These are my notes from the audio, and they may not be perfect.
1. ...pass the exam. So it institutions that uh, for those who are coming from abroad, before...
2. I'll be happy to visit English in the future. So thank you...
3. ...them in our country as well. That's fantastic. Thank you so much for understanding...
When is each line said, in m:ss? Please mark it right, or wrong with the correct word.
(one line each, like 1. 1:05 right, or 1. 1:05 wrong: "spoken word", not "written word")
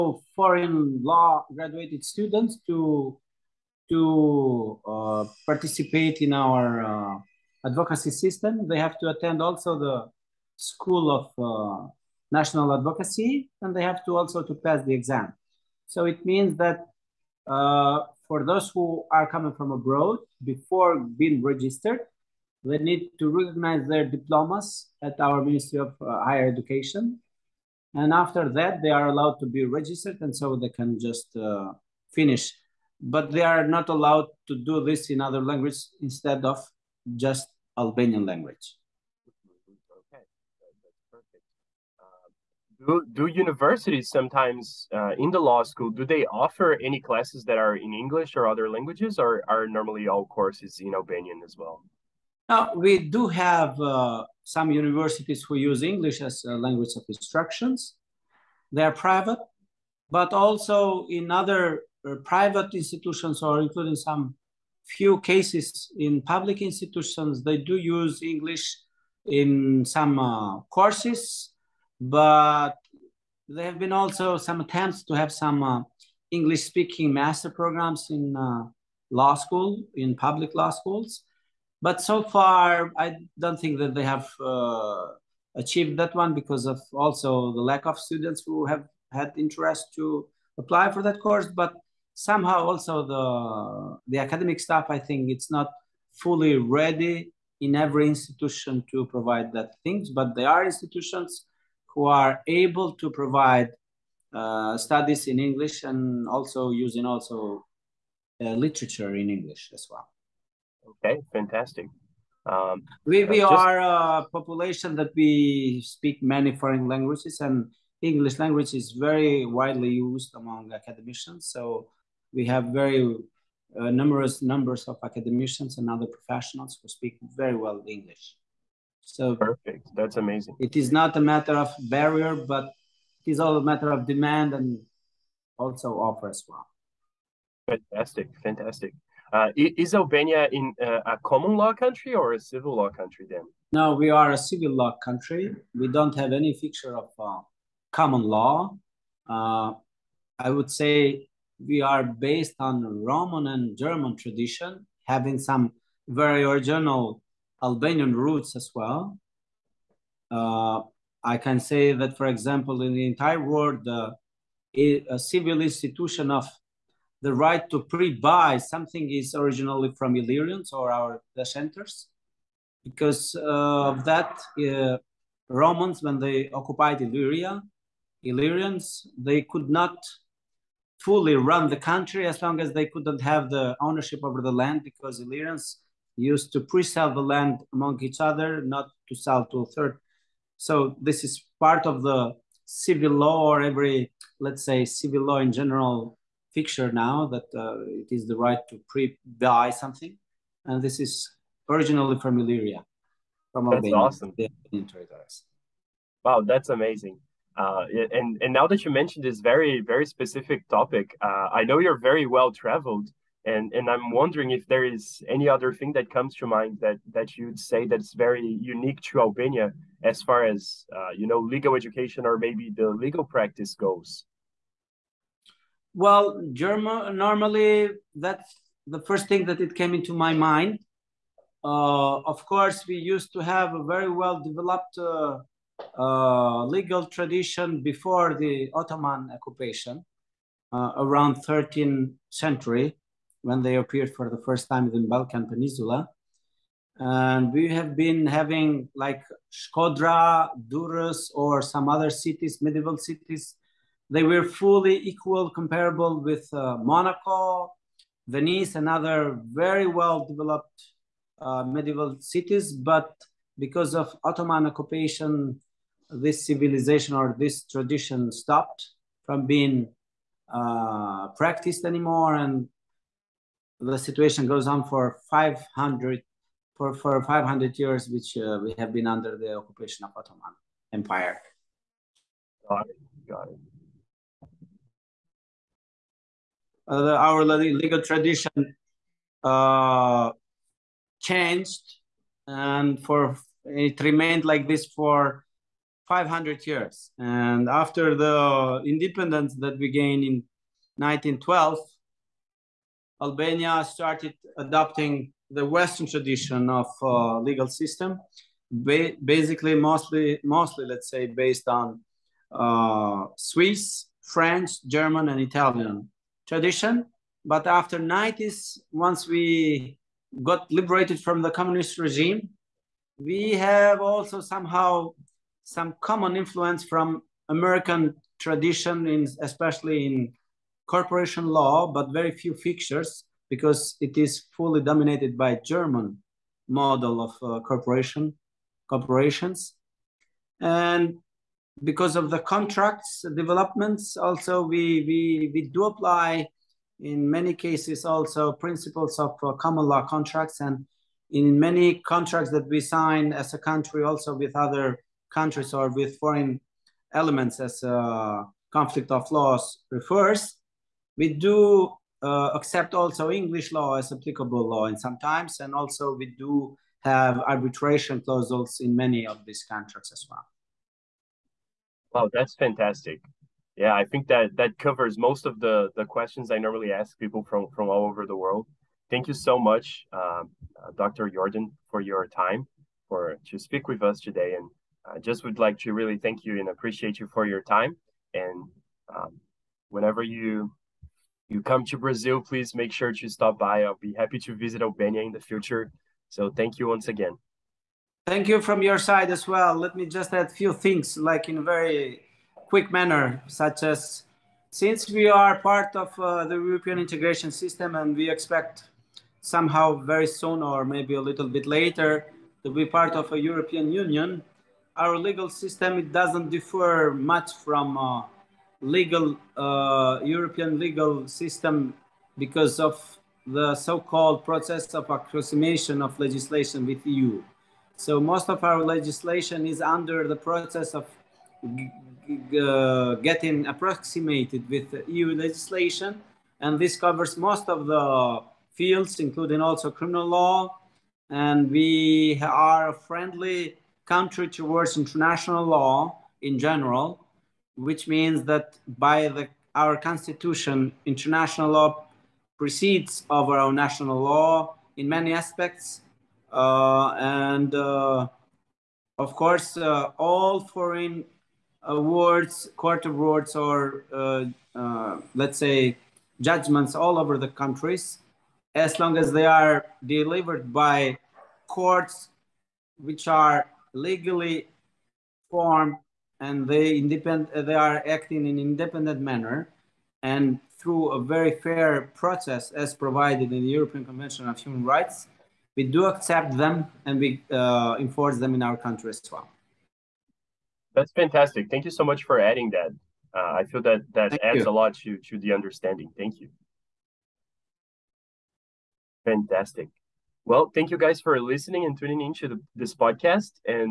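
1. 0:14 wrong: "means", not "institutions"
2. 6:33 wrong: "Albania", not "English"
3. 8:08 wrong: "adding", not "understanding".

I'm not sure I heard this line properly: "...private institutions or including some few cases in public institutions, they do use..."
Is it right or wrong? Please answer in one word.
right.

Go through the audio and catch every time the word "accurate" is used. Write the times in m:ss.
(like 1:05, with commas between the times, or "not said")
not said.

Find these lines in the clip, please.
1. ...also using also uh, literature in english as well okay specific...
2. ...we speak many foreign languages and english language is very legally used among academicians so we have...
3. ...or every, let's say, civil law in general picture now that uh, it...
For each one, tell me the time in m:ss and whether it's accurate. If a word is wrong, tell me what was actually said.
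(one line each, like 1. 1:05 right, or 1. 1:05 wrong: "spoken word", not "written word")
1. 1:46 wrong: "fantastic", not "specific"
2. 1:55 wrong: "widely", not "legally"
3. 3:13 right.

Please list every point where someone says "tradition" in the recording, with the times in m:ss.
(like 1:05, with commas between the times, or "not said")
2:34, 3:57, 4:27, 4:48, 5:06, 5:16, 5:28.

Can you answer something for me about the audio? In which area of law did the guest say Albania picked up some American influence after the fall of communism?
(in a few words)
corporation law.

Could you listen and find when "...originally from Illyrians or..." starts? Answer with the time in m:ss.
2:49.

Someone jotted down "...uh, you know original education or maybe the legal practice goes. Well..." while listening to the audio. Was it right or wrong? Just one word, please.
wrong.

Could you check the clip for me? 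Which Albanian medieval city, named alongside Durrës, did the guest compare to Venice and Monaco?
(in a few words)
Shkodra.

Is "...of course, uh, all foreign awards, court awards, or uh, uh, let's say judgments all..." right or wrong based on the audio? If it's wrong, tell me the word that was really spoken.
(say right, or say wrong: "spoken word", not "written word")
right.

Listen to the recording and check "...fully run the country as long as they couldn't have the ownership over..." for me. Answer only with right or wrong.
right.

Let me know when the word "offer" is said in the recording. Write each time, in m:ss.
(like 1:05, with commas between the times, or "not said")
0:46, 2:15.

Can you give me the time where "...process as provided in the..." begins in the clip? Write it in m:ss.
8:02.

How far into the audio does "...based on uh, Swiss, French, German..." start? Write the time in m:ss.
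5:11.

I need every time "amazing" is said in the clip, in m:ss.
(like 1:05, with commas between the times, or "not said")
2:10, 3:26.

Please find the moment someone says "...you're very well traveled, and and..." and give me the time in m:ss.
3:31.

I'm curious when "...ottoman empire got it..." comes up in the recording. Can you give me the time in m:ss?
4:40.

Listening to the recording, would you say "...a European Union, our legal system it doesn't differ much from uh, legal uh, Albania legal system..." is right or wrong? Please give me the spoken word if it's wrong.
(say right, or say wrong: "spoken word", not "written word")
wrong: "European", not "Albania".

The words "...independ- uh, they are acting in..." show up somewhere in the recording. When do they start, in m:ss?
7:56.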